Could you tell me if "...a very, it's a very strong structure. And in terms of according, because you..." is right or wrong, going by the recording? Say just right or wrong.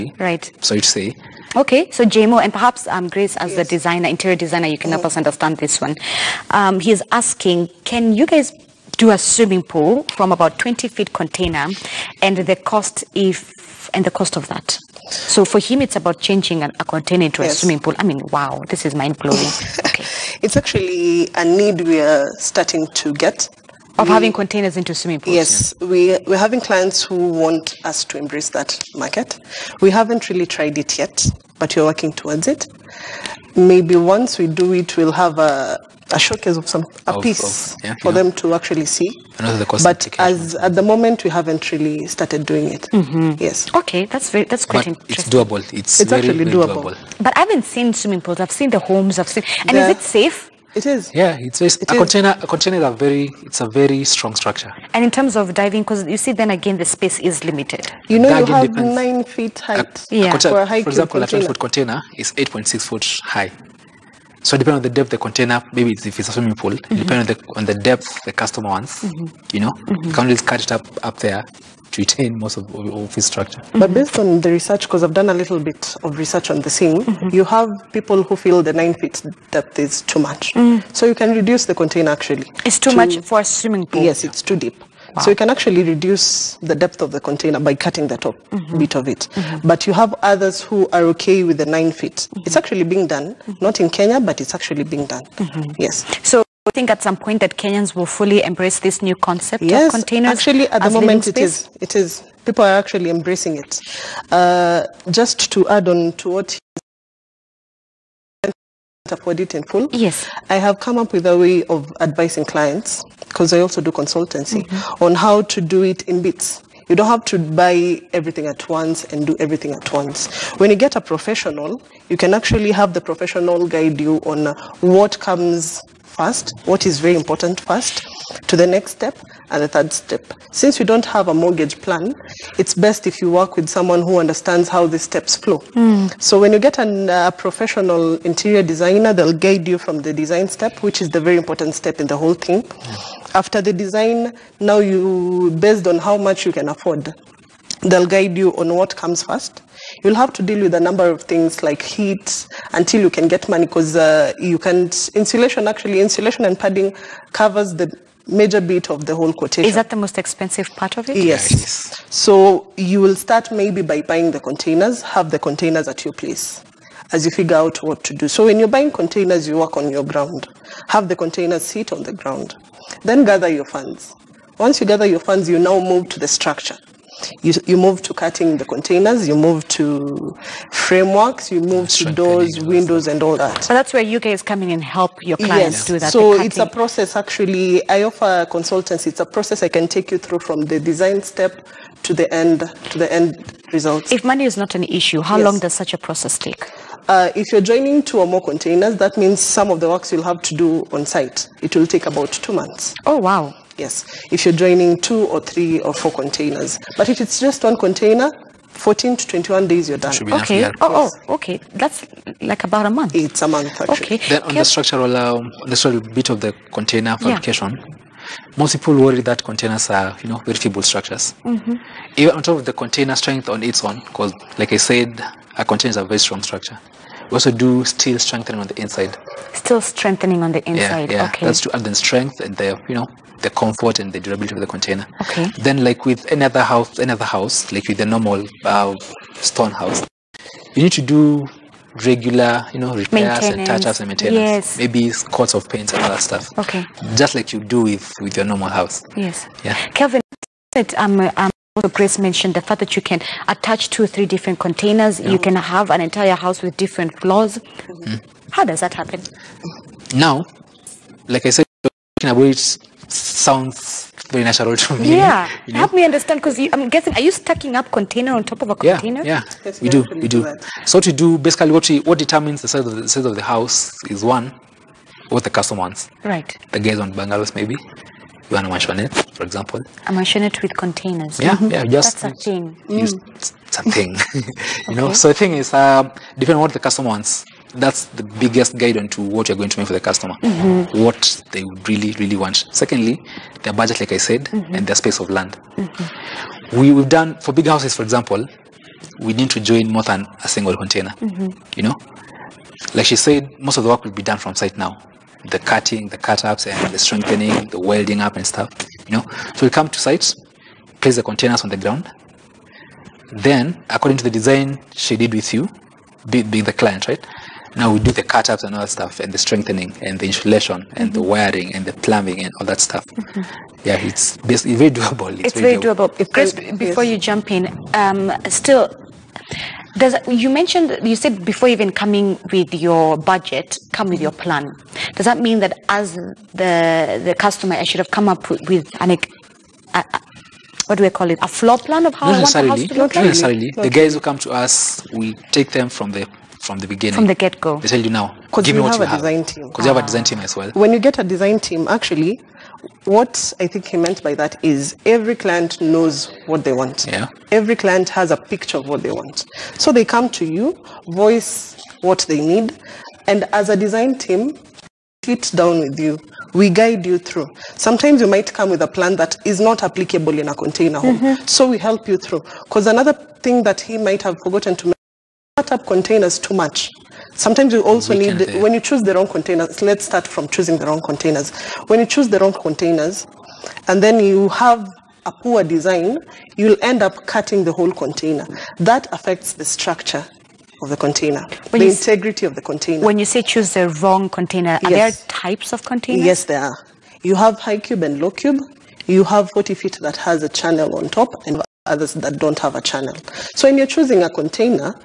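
wrong.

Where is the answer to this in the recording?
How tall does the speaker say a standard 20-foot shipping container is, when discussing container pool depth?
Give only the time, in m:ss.
1:02.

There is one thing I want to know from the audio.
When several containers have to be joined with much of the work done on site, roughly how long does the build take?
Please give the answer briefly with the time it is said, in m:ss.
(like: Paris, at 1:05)
2 months, at 3:22.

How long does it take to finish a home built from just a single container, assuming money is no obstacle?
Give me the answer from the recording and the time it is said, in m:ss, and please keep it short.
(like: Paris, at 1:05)
14 to 21 days, at 3:28.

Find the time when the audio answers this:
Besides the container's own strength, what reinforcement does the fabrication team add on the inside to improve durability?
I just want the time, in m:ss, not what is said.
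3:47.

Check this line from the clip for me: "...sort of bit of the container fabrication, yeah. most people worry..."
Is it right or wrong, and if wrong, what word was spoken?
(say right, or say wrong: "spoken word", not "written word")
right.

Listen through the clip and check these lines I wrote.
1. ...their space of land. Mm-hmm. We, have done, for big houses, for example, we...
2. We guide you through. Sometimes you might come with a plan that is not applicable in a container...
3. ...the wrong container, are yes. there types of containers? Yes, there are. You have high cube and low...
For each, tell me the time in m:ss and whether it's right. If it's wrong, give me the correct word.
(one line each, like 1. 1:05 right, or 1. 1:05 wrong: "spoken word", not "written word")
1. 4:54 right
2. 6:06 right
3. 6:33 right.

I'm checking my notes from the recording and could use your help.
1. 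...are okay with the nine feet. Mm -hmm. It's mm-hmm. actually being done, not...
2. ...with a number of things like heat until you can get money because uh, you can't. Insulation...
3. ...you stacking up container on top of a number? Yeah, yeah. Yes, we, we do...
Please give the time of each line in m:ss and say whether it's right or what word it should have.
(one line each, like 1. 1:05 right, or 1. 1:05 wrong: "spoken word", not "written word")
1. 1:30 right
2. 2:30 right
3. 4:27 wrong: "container", not "number".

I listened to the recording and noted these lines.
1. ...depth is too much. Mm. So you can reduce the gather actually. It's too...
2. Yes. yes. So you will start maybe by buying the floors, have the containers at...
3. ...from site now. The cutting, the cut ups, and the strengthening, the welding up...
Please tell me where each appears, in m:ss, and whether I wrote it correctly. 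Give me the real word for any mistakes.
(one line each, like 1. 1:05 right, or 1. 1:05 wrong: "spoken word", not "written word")
1. 1:19 wrong: "container", not "gather"
2. 2:41 wrong: "containers", not "floors"
3. 5:04 right.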